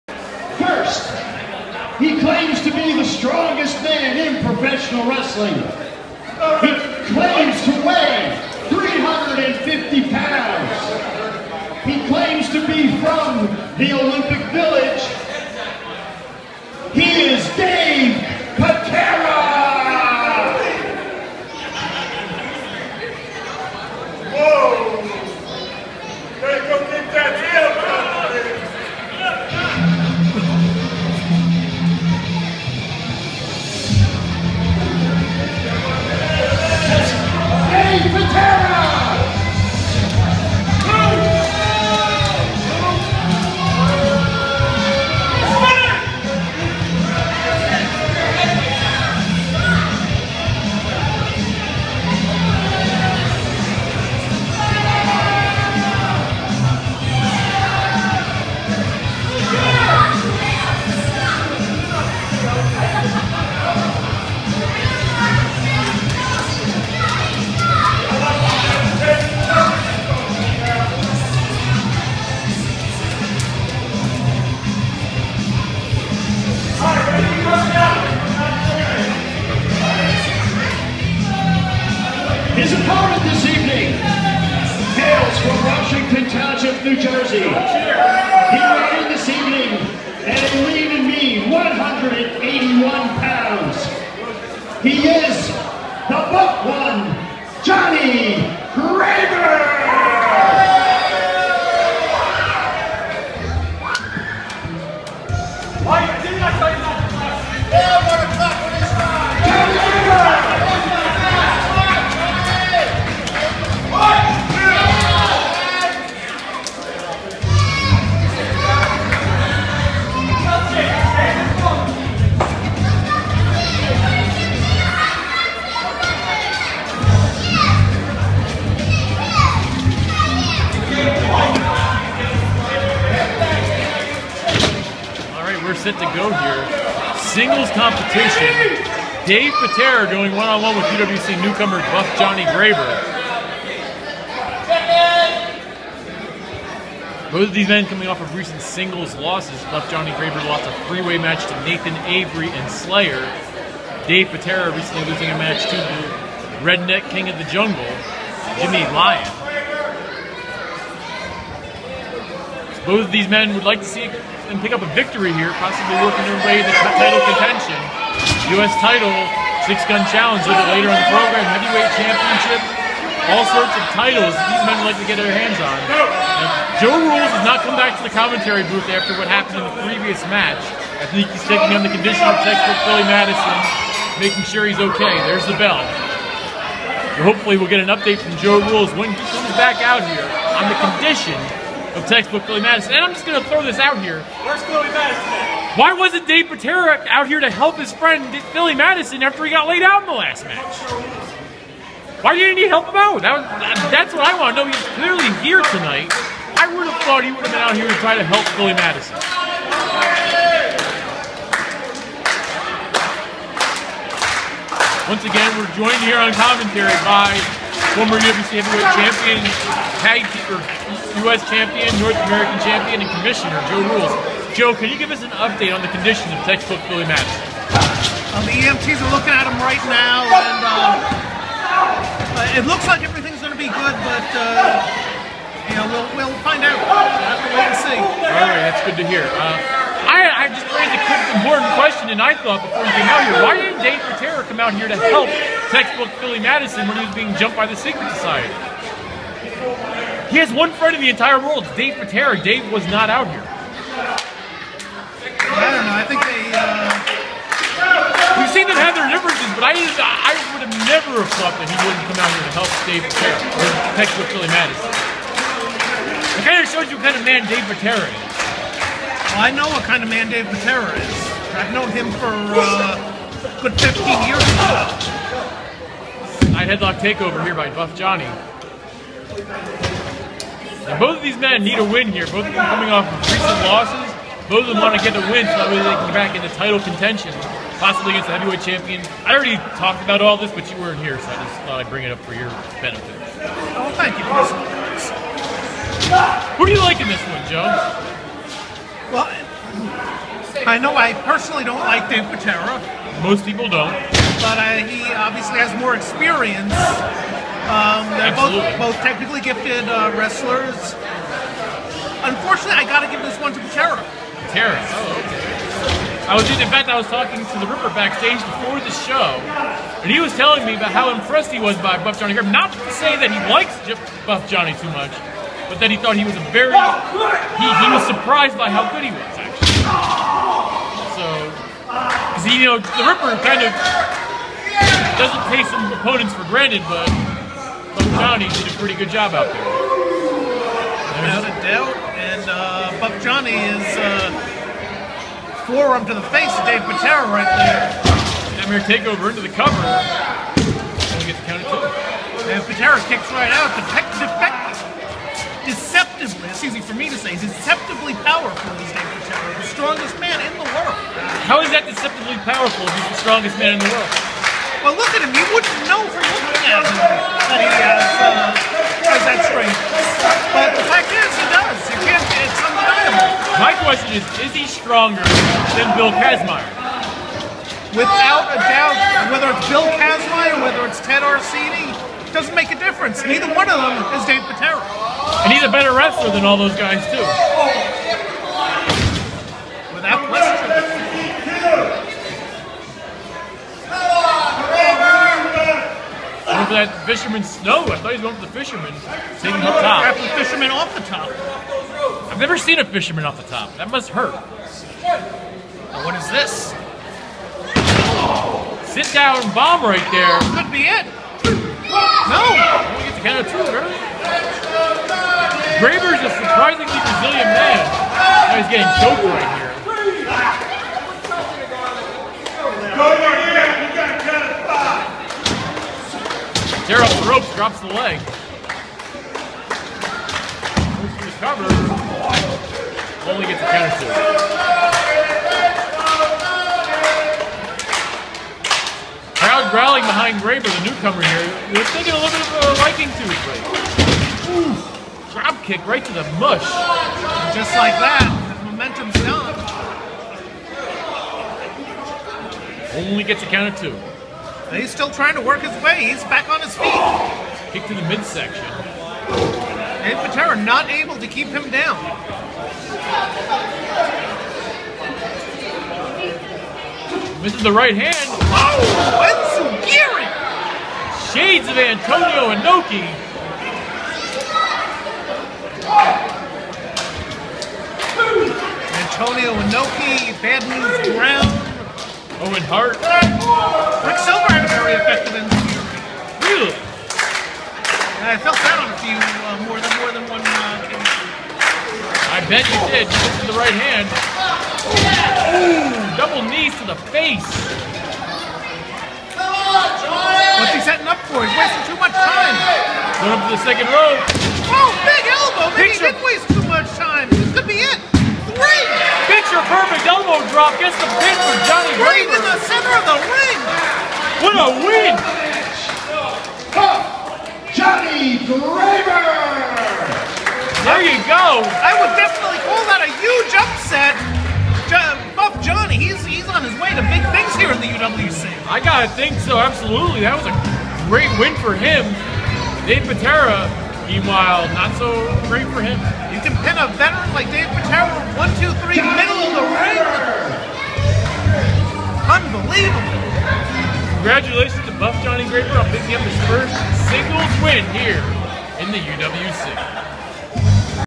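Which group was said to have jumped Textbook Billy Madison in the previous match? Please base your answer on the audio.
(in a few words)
the Secret Society.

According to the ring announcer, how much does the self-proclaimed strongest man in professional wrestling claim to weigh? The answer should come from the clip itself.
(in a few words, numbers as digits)
350 pounds.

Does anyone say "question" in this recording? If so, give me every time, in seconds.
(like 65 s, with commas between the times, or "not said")
241 s, 373 s, 390 s.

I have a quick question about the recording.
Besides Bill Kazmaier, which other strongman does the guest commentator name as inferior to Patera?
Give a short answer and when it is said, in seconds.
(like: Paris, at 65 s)
Ted Arcidi, at 381 s.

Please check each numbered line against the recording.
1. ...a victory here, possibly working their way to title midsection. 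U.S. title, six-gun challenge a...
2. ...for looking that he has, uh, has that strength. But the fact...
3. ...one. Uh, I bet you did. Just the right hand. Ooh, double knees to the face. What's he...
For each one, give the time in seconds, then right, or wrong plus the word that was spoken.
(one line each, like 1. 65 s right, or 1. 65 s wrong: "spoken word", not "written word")
1. 164 s wrong: "contention", not "midsection"
2. 366 s right
3. 490 s right.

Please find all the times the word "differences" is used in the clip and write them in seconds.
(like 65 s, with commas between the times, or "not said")
259 s, 382 s.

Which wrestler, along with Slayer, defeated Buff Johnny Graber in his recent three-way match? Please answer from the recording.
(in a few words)
Nathan Avery.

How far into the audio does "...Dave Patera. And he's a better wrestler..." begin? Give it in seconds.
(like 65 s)
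384 s.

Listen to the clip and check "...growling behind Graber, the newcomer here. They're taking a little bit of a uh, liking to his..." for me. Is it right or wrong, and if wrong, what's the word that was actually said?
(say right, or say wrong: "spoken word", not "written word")
right.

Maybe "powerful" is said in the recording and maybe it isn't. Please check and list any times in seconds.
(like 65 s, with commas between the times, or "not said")
358 s, 362 s.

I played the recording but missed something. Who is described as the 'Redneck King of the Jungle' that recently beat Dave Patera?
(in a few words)
Jimmy Lyon.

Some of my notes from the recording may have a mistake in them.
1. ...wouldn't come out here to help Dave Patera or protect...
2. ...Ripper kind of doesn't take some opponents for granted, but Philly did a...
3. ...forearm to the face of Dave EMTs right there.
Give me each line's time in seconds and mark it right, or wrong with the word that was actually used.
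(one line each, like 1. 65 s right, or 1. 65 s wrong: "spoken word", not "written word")
1. 261 s right
2. 333 s wrong: "Johnny", not "Philly"
3. 345 s wrong: "Patera", not "EMTs".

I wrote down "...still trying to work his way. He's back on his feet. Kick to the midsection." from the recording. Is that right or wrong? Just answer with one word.
right.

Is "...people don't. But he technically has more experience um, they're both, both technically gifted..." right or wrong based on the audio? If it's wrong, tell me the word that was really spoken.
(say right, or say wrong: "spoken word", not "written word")
wrong: "obviously", not "technically".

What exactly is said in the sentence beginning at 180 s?
I think he's taking on the condition of Texas Philly Madison, making sure he's okay.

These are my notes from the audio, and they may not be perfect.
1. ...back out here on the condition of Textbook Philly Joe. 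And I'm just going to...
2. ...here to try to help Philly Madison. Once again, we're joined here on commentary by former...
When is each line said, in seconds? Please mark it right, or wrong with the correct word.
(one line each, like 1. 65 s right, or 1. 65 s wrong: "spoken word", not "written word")
1. 189 s wrong: "Madison", not "Joe"
2. 207 s right.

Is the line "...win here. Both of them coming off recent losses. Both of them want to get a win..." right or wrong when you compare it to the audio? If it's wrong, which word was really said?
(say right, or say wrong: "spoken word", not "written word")
right.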